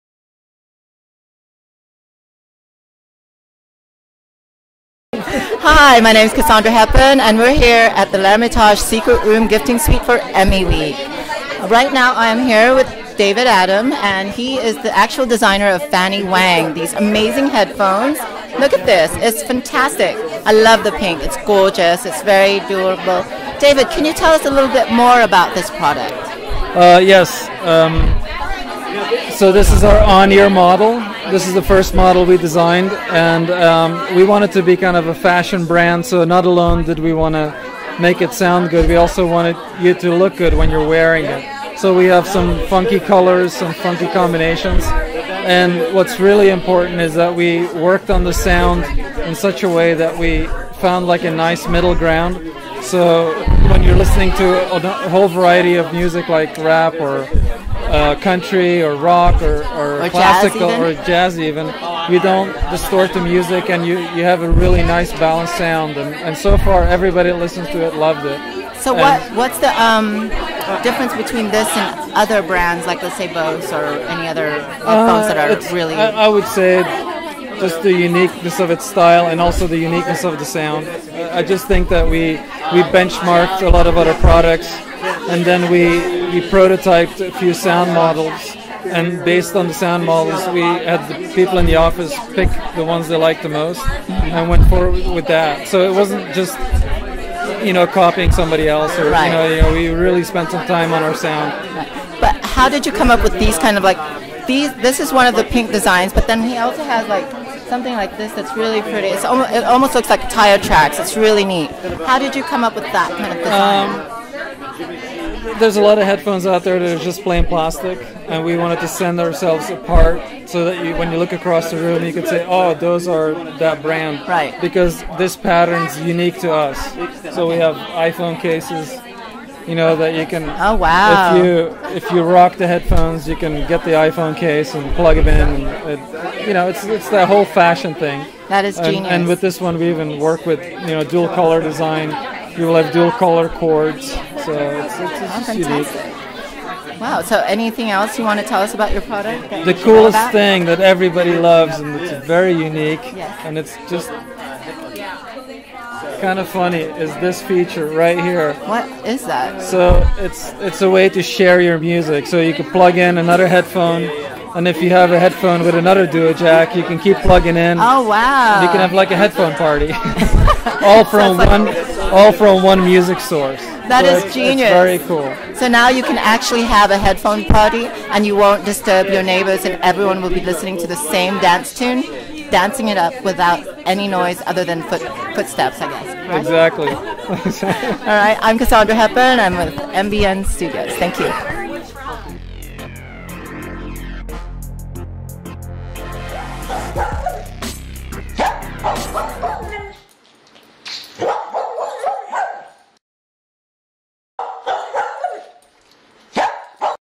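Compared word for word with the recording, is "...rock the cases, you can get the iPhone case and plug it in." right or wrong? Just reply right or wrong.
wrong.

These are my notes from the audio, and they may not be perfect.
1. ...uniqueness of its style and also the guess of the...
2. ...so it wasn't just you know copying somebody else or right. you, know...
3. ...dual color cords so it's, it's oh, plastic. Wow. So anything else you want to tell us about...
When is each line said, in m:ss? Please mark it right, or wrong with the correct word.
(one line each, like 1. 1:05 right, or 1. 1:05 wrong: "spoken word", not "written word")
1. 1:17 wrong: "uniqueness", not "guess"
2. 1:35 right
3. 2:22 wrong: "fantastic", not "plastic".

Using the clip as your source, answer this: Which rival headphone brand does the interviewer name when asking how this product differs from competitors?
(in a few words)
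Bose.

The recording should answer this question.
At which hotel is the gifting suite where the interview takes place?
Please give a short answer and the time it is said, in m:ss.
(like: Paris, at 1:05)
L'Ermitage, at 0:08.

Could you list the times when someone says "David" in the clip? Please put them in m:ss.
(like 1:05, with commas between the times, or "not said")
0:13, 0:23.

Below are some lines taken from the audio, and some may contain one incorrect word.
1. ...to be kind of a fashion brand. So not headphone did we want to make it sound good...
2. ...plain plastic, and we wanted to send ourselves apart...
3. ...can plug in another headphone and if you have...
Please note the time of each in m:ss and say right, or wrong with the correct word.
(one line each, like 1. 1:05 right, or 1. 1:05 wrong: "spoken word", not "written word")
1. 0:34 wrong: "alone", not "headphone"
2. 1:57 right
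3. 2:42 right.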